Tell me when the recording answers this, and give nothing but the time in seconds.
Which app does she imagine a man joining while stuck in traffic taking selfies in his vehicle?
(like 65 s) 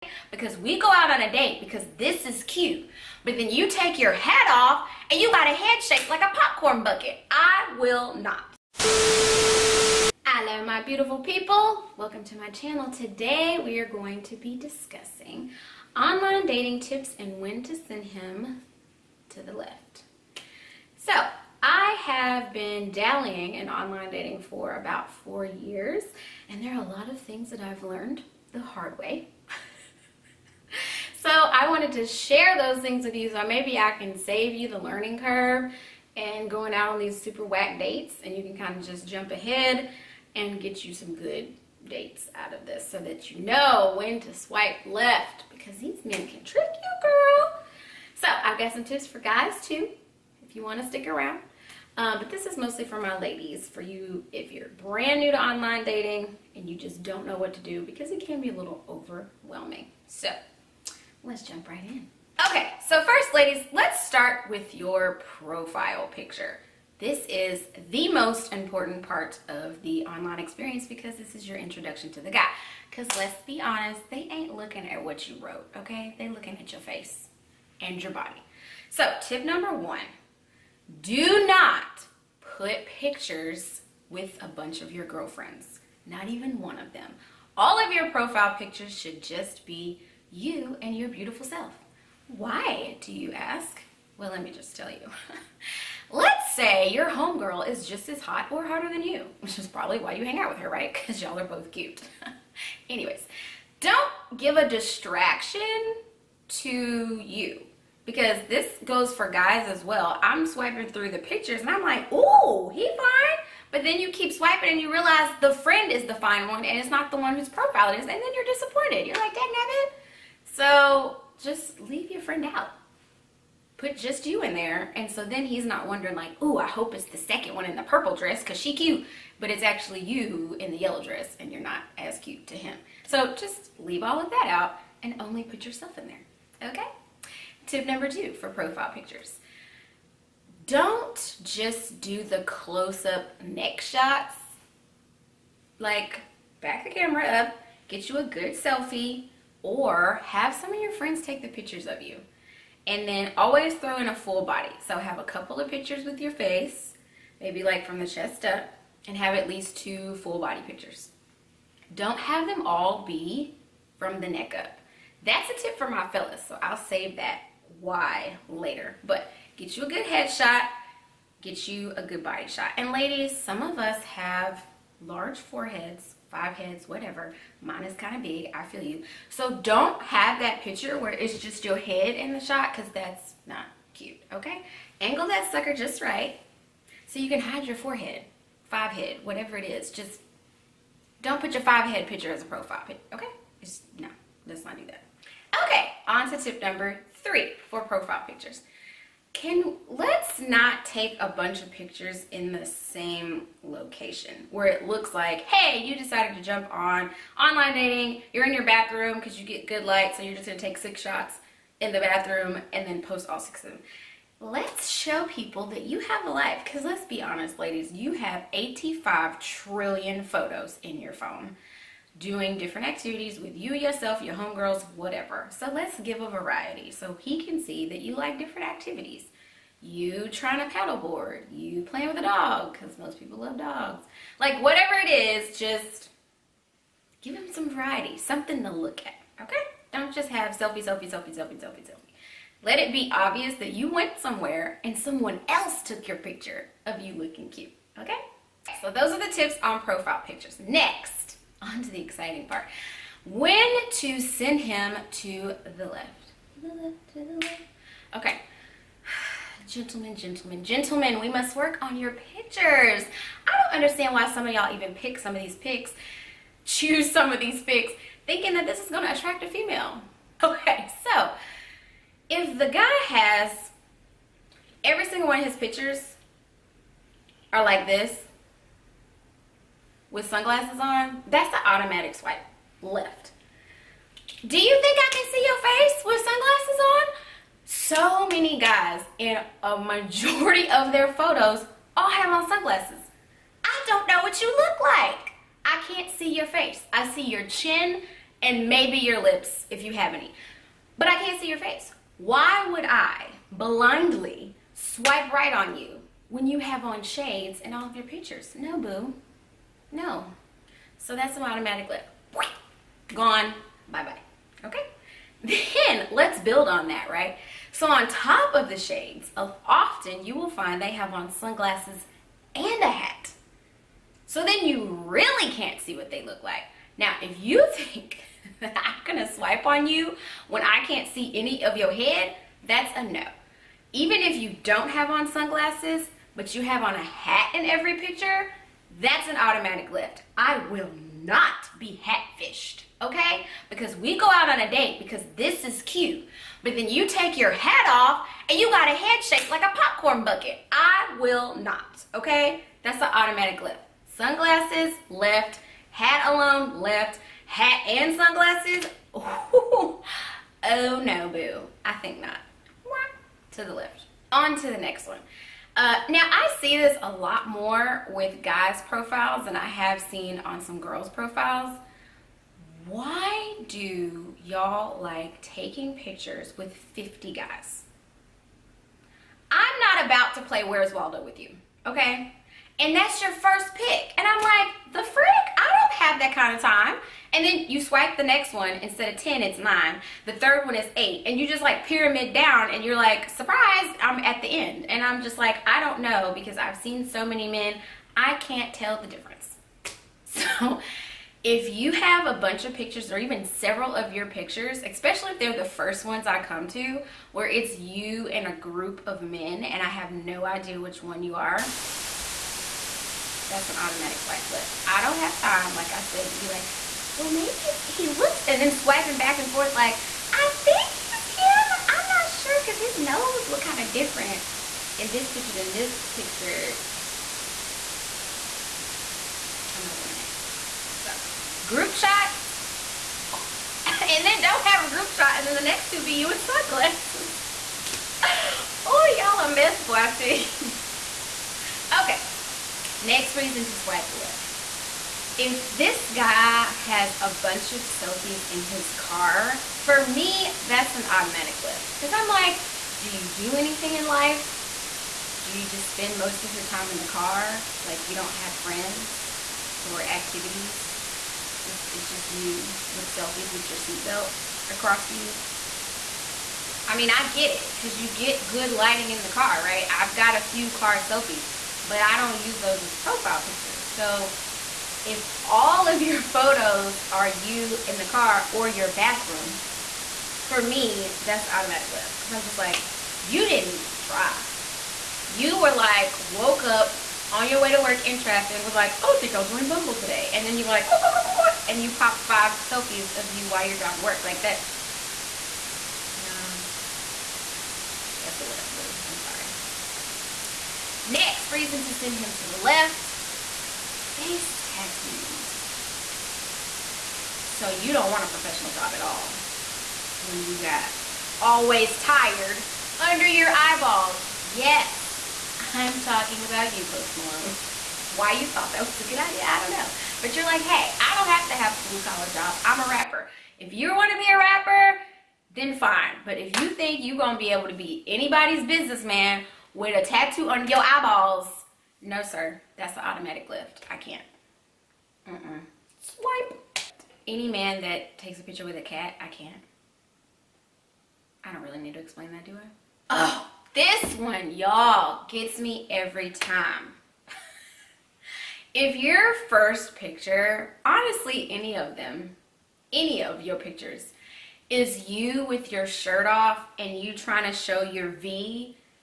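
489 s.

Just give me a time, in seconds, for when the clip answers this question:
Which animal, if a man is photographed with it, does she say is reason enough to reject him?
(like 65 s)
538 s.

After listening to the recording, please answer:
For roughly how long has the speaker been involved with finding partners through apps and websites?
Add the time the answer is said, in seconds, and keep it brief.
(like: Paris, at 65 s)
4 years, at 25 s.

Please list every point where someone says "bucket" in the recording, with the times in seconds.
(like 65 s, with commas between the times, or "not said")
6 s, 350 s.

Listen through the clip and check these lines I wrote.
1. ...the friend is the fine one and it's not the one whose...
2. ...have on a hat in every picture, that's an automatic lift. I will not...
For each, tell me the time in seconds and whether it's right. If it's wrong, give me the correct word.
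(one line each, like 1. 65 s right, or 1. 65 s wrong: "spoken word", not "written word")
1. 115 s right
2. 336 s right.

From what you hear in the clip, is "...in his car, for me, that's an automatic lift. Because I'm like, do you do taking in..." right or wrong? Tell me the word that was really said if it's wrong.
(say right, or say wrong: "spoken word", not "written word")
wrong: "anything", not "taking".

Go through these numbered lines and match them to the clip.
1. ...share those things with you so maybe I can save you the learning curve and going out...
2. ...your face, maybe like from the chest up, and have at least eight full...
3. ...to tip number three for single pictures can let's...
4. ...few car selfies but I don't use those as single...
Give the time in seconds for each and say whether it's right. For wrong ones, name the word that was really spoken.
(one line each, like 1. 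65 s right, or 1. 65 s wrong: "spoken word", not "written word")
1. 32 s right
2. 156 s wrong: "two", not "eight"
3. 196 s wrong: "profile", not "single"
4. 470 s wrong: "profile", not "single".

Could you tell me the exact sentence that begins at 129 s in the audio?
But it's actually you in the yellow dress and you're not as cute to him.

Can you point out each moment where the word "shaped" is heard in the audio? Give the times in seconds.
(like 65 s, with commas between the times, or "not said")
5 s, 349 s.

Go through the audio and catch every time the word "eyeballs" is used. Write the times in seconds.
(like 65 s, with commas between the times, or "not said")
513 s, 530 s.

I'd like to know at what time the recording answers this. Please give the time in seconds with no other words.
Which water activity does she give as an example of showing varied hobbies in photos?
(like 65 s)
230 s.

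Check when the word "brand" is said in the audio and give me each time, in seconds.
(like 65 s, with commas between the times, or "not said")
54 s.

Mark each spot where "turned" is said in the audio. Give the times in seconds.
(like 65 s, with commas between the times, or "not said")
not said.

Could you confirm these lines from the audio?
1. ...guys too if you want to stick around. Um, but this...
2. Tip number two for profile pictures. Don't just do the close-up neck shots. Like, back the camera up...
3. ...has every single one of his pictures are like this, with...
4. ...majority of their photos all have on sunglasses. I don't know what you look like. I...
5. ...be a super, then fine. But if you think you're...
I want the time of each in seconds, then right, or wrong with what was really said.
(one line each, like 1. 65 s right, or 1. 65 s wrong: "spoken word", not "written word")
1. 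49 s right
2. 137 s right
3. 273 s right
4. 289 s right
5. 524 s wrong: "rapper", not "super".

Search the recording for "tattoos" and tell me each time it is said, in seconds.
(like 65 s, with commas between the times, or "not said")
504 s, 530 s.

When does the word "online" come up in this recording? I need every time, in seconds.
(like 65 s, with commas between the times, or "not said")
15 s, 23 s, 55 s, 70 s, 207 s.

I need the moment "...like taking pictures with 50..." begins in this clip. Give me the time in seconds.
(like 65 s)
375 s.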